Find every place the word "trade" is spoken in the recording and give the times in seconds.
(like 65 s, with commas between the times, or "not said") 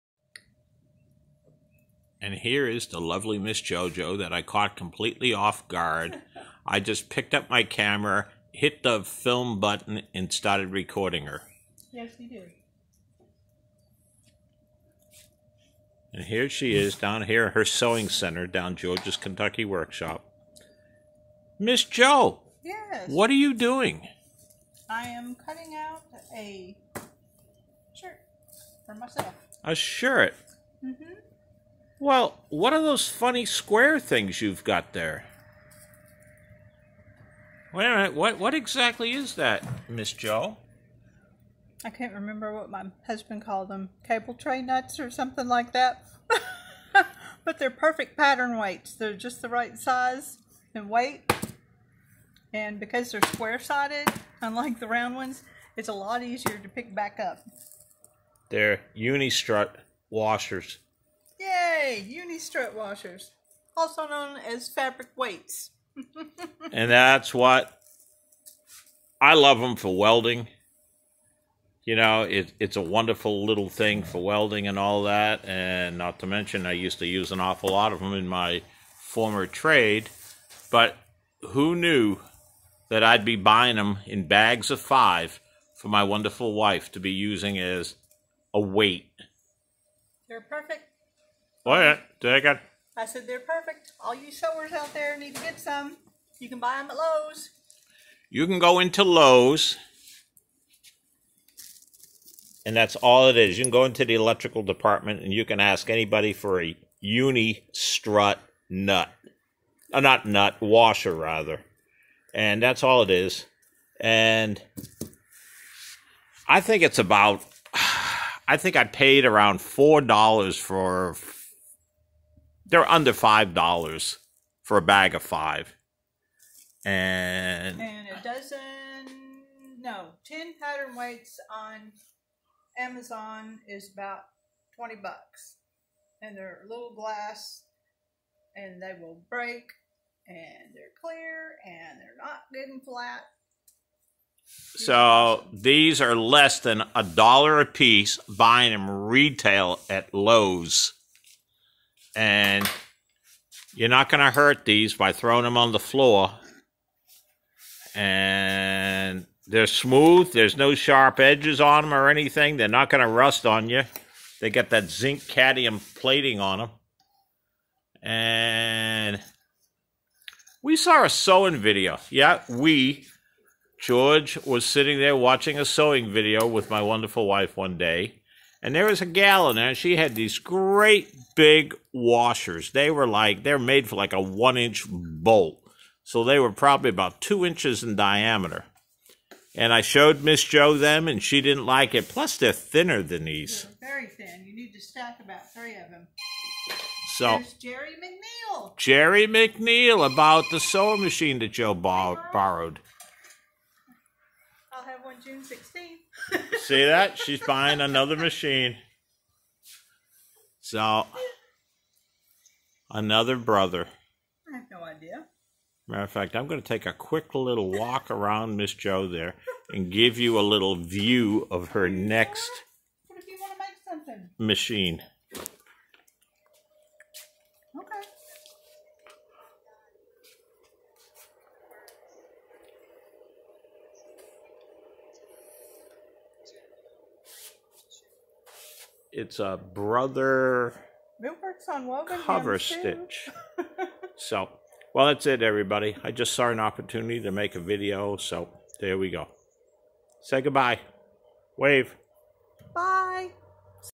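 79 s.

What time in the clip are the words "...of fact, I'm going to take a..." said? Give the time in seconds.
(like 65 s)
216 s.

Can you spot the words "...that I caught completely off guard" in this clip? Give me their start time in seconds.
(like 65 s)
4 s.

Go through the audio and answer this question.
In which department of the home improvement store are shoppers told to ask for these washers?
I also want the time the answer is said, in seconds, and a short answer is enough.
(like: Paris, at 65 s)
Electrical department, at 104 s.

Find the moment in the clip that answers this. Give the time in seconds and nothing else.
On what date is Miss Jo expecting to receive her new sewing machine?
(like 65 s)
205 s.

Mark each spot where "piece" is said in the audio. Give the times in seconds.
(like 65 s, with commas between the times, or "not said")
147 s.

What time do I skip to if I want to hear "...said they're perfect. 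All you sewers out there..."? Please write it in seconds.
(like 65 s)
93 s.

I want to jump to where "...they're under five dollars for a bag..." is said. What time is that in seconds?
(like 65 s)
122 s.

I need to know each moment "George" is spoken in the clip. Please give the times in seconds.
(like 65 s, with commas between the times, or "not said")
18 s, 173 s.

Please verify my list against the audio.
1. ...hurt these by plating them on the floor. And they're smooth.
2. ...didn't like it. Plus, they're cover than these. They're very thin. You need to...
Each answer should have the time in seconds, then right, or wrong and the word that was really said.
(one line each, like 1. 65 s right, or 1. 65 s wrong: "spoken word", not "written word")
1. 154 s wrong: "throwing", not "plating"
2. 191 s wrong: "thinner", not "cover".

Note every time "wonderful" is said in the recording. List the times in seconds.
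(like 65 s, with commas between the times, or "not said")
72 s, 86 s, 176 s.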